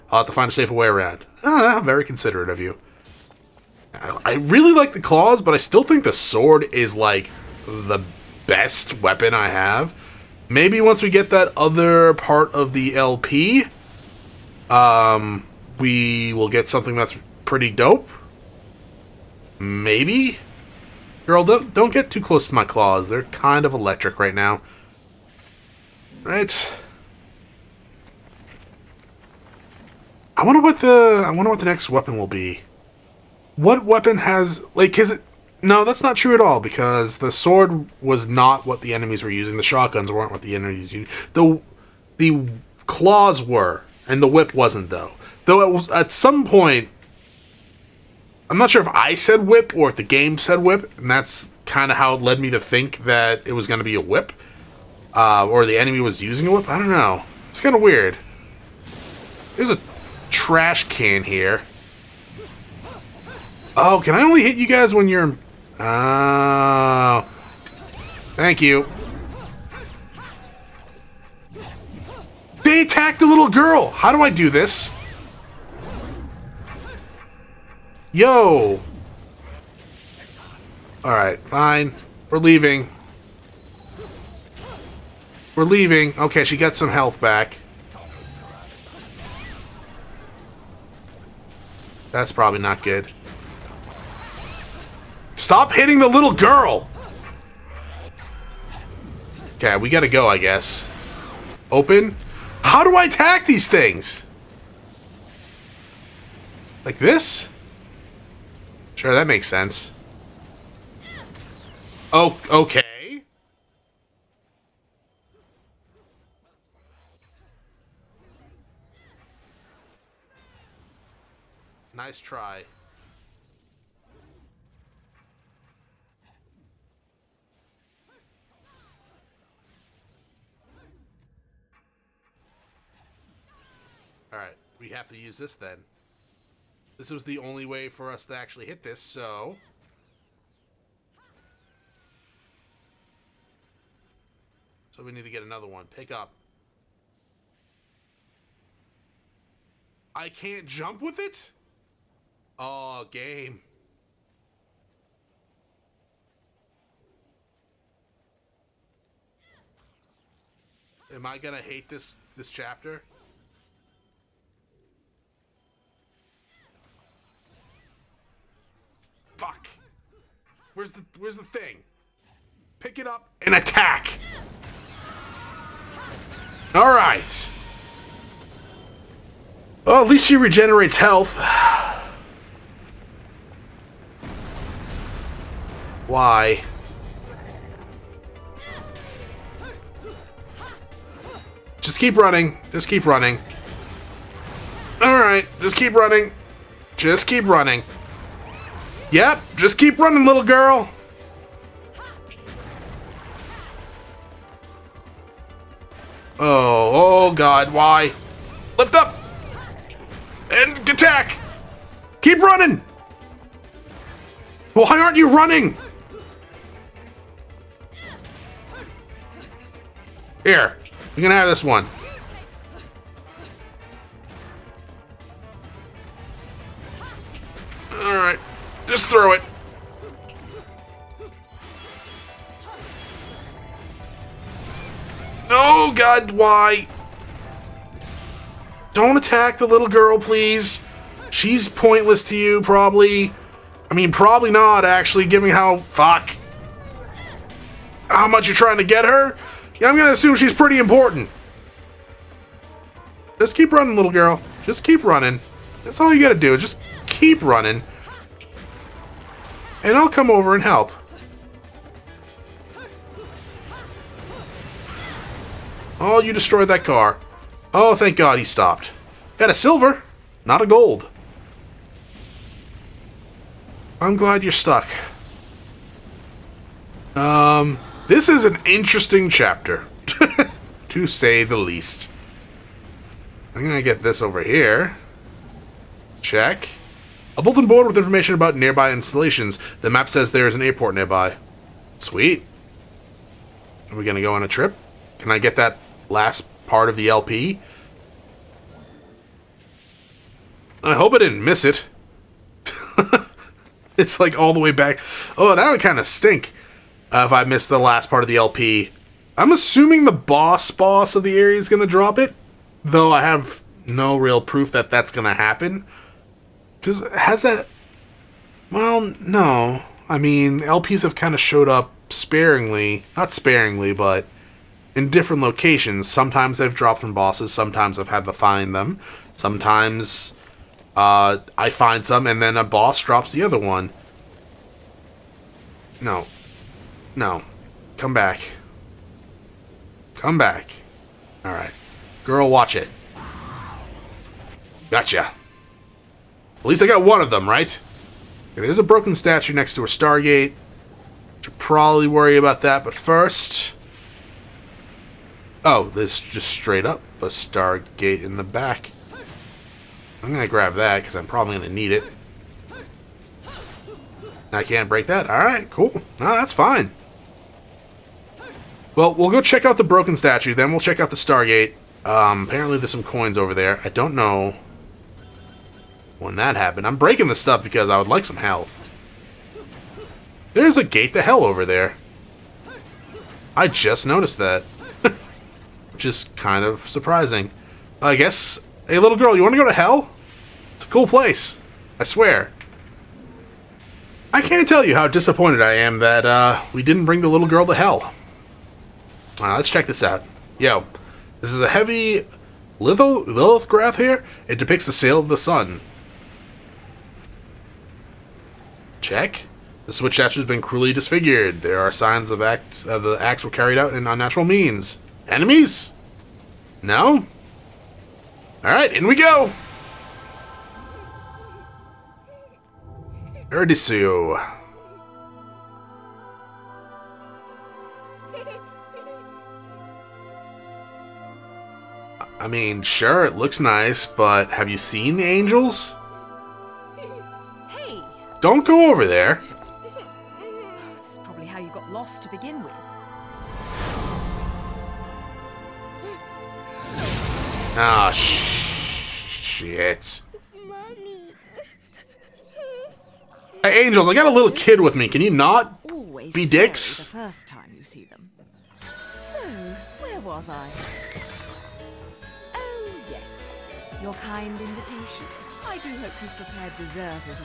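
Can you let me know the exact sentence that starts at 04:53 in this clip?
Are we going to go on a trip?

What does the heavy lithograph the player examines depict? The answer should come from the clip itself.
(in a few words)
The sail of the sun.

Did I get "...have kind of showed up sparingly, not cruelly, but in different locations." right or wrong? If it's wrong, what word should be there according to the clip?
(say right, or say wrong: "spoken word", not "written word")
wrong: "sparingly", not "cruelly".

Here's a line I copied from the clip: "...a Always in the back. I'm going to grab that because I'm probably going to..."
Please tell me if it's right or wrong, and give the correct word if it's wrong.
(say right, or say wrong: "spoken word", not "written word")
wrong: "Stargate", not "Always".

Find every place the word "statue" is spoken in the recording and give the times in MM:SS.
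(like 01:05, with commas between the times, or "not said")
05:49, 06:10, 06:50.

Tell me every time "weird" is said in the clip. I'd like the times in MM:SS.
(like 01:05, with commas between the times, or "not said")
00:57.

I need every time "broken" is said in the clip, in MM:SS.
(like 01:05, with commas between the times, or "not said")
05:48, 06:09.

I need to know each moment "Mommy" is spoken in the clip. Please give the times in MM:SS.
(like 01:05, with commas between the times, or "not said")
07:30.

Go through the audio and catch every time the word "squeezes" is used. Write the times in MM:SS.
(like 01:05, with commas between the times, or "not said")
not said.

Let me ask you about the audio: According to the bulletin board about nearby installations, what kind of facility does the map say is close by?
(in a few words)
An airport.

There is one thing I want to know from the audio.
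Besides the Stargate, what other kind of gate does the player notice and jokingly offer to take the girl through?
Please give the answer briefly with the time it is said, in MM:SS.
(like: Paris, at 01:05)
A gate to hell, at 06:20.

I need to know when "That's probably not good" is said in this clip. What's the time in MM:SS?
01:32.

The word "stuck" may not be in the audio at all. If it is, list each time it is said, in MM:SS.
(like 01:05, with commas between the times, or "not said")
04:34.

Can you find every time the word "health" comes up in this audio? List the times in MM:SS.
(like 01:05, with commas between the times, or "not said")
01:26, 03:00, 06:18.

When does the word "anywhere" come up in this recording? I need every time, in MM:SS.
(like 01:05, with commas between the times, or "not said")
not said.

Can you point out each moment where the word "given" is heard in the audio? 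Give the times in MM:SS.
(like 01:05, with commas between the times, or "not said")
04:05.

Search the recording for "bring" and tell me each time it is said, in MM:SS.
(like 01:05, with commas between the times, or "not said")
06:37.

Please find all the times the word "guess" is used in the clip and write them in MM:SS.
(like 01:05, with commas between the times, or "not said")
01:40, 06:28.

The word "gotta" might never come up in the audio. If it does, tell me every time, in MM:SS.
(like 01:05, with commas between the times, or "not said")
01:39, 04:16.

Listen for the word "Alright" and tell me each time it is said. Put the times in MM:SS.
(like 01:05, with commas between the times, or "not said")
01:21, 03:15, 06:05, 06:58.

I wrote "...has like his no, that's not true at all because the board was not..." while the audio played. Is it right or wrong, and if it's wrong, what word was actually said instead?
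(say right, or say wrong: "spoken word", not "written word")
wrong: "sword", not "board".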